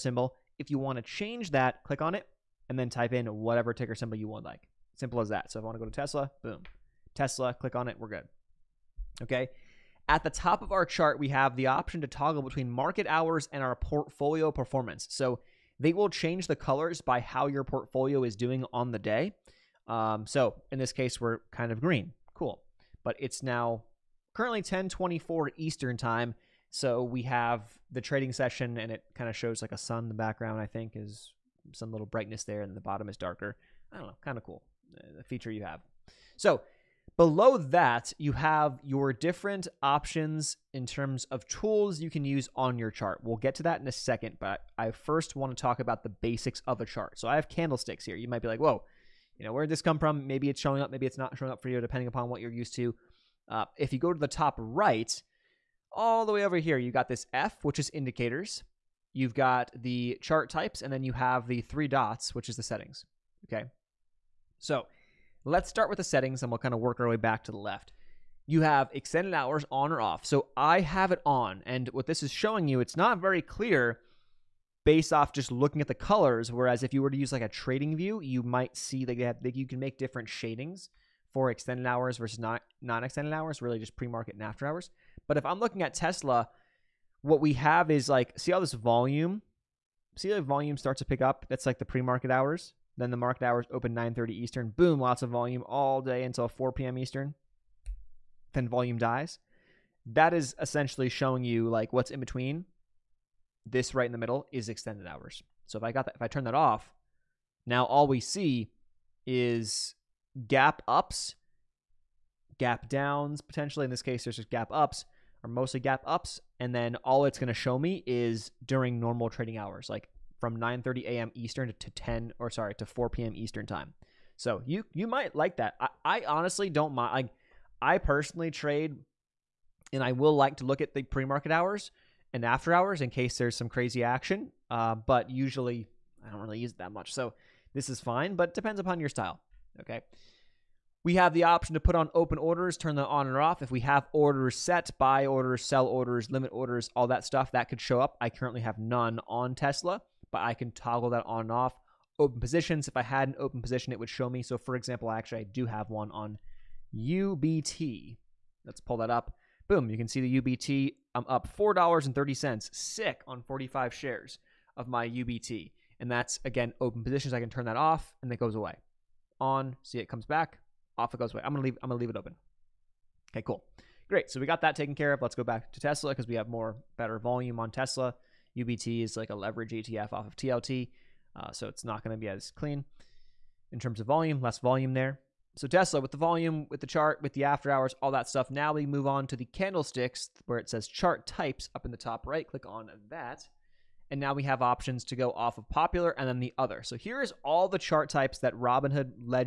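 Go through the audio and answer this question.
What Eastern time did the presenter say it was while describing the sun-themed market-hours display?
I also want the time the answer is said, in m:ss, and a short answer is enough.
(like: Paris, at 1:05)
10:24, at 0:24.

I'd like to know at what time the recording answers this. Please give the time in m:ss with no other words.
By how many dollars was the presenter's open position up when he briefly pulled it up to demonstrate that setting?
2:41.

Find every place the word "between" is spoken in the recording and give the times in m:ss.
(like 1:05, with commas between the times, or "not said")
0:12, 1:42.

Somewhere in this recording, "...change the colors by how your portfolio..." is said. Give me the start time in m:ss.
0:16.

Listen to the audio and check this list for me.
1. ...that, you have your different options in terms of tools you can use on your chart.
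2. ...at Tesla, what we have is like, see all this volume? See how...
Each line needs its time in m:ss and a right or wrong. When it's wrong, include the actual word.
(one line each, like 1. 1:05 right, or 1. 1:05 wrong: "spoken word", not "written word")
1. 0:37 right
2. 1:25 right.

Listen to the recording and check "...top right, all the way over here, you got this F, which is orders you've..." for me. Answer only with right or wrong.
wrong.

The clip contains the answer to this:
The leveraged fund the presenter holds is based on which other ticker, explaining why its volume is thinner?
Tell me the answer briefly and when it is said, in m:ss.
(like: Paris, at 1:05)
TLT, at 3:00.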